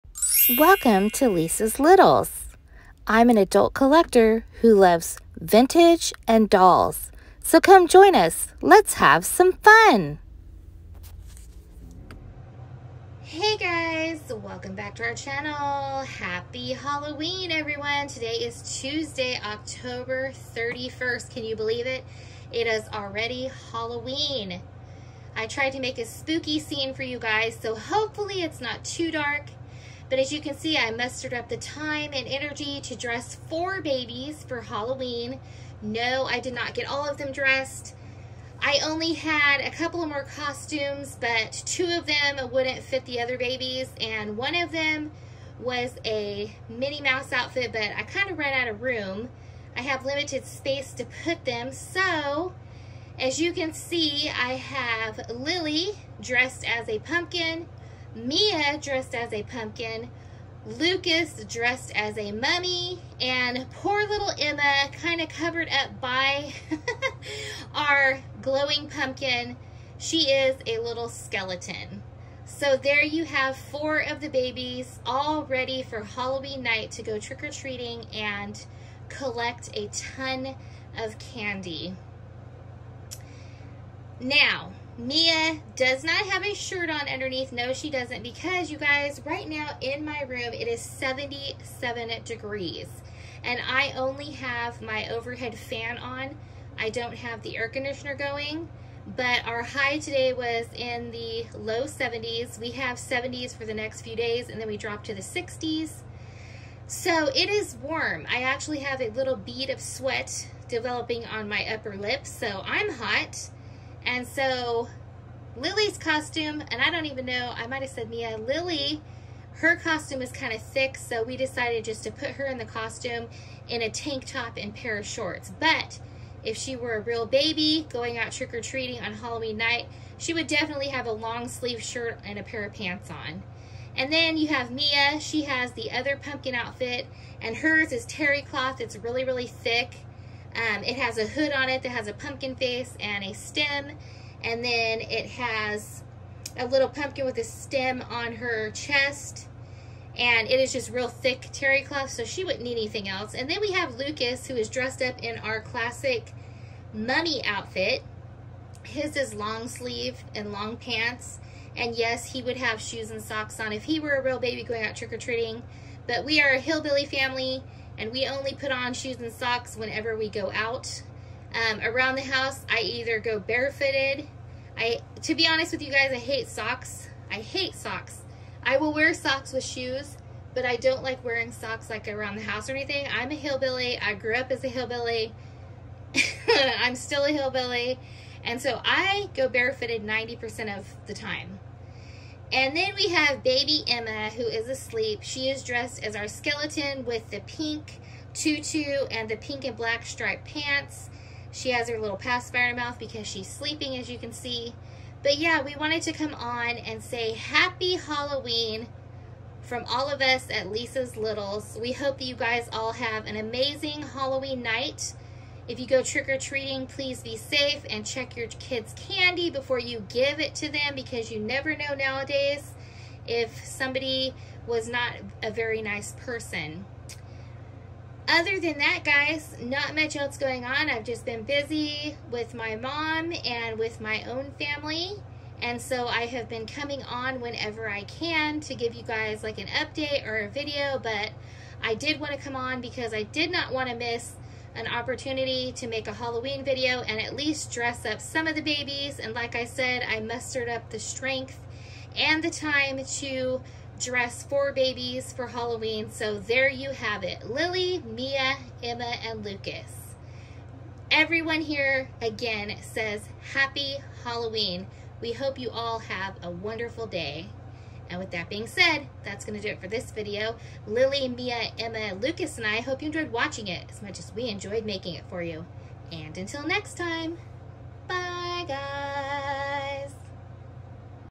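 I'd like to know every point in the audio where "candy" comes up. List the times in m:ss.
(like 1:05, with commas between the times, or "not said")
1:21, 3:38.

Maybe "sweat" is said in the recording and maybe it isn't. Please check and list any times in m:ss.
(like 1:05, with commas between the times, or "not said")
1:49.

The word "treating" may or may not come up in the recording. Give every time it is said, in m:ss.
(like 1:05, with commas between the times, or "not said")
1:17, 2:08, 2:44, 3:36.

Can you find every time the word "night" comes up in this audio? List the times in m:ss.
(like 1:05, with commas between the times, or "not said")
1:16, 2:09, 3:34.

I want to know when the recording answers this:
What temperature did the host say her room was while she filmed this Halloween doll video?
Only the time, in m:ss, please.
1:30.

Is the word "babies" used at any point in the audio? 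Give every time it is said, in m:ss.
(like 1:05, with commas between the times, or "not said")
0:33, 0:43, 1:14, 4:08, 4:14.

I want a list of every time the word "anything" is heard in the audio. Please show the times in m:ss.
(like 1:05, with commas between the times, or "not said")
2:32, 3:02.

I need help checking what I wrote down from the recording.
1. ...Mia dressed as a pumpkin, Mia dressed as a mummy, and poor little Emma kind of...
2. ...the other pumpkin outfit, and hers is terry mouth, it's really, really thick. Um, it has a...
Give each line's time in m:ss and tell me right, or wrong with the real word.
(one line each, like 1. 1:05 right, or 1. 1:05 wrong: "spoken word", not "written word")
1. 0:58 wrong: "Lucas", not "Mia"
2. 2:15 wrong: "cloth", not "mouth".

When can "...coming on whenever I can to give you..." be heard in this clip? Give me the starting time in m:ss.
3:56.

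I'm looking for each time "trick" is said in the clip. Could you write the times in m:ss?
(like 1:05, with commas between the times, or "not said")
1:17, 2:08, 2:44, 3:36.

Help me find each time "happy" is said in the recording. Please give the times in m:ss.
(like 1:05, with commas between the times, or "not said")
0:16, 3:27, 4:23.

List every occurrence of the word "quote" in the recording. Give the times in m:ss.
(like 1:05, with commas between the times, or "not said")
not said.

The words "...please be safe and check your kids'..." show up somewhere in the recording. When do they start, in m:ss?
3:36.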